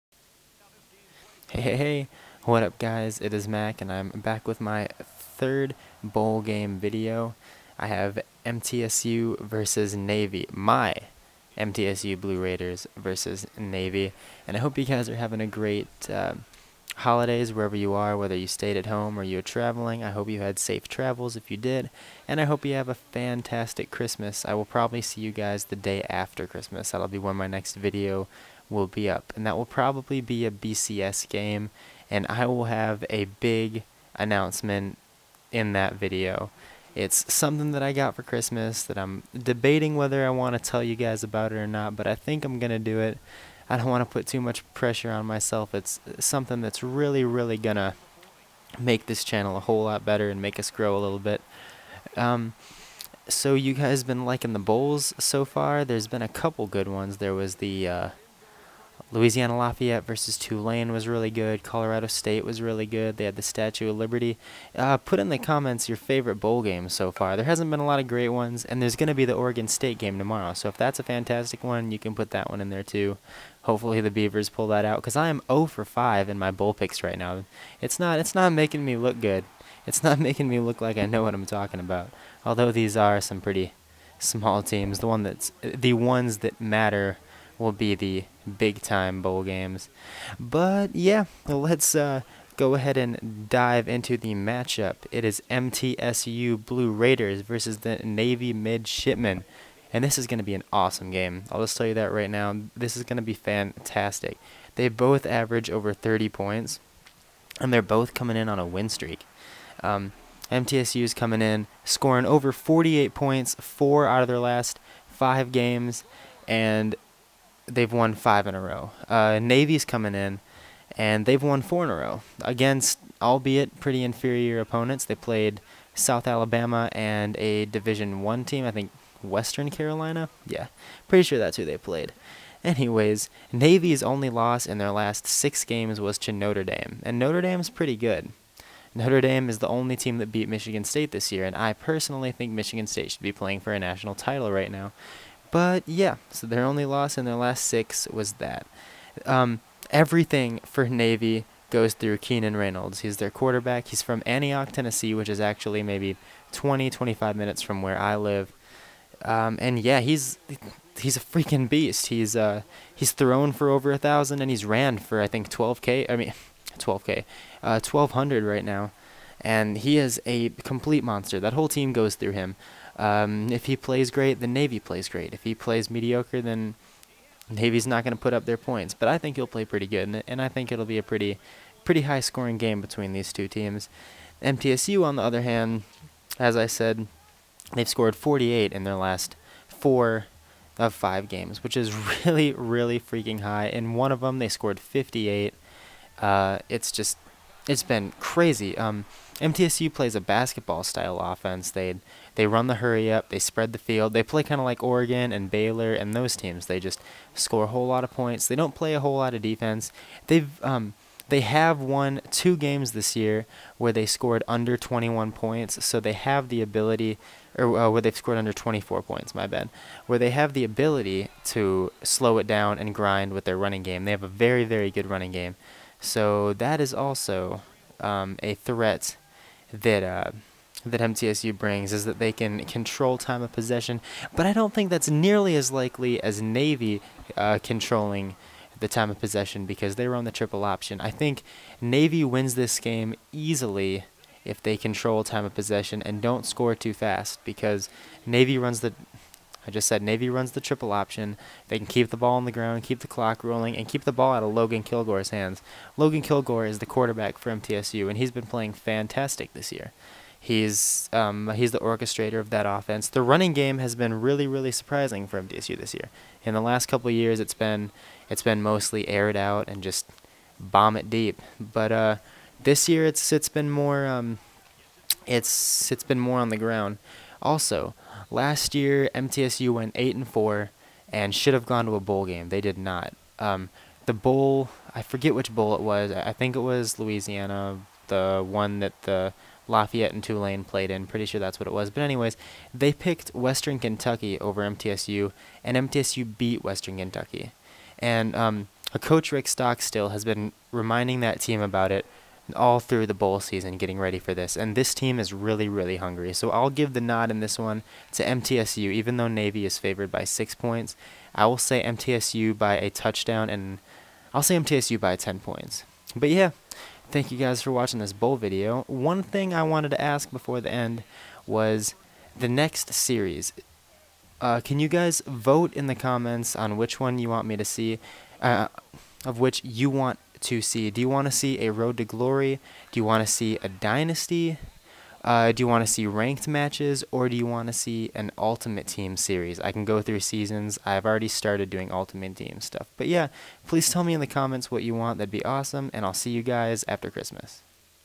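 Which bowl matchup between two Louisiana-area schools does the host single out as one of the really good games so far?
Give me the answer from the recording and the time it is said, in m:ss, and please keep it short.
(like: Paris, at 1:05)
Louisiana Lafayette versus Tulane, at 0:59.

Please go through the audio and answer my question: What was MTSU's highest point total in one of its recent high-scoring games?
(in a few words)
58.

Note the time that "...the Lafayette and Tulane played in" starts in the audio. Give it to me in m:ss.
4:49.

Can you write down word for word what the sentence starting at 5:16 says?
But yeah, Thank you guys for watching this bowl video.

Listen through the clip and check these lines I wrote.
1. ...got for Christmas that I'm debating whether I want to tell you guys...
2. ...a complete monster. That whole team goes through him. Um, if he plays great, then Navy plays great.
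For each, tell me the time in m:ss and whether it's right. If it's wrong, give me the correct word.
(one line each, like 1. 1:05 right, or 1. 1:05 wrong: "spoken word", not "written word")
1. 0:37 right
2. 2:50 right.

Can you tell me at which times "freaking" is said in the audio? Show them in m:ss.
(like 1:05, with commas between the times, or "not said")
2:41, 3:12.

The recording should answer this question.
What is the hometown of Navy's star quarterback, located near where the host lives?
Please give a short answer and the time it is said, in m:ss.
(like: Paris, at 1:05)
Antioch, Tennessee, at 2:34.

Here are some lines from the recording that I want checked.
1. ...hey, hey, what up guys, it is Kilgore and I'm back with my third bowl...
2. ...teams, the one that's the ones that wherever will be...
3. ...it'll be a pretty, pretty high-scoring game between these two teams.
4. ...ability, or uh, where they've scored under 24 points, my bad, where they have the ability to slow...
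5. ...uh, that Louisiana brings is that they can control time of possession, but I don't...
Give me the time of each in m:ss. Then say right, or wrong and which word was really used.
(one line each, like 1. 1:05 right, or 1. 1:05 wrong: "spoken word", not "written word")
1. 0:01 wrong: "Mac", not "Kilgore"
2. 1:24 wrong: "matter", not "wherever"
3. 3:00 right
4. 3:36 right
5. 3:50 wrong: "MTSU", not "Louisiana".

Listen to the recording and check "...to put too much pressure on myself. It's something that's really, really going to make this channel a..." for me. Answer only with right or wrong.
right.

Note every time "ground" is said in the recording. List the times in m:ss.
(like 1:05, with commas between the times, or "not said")
4:12, 4:36.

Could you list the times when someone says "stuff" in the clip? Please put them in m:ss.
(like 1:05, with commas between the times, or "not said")
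5:42.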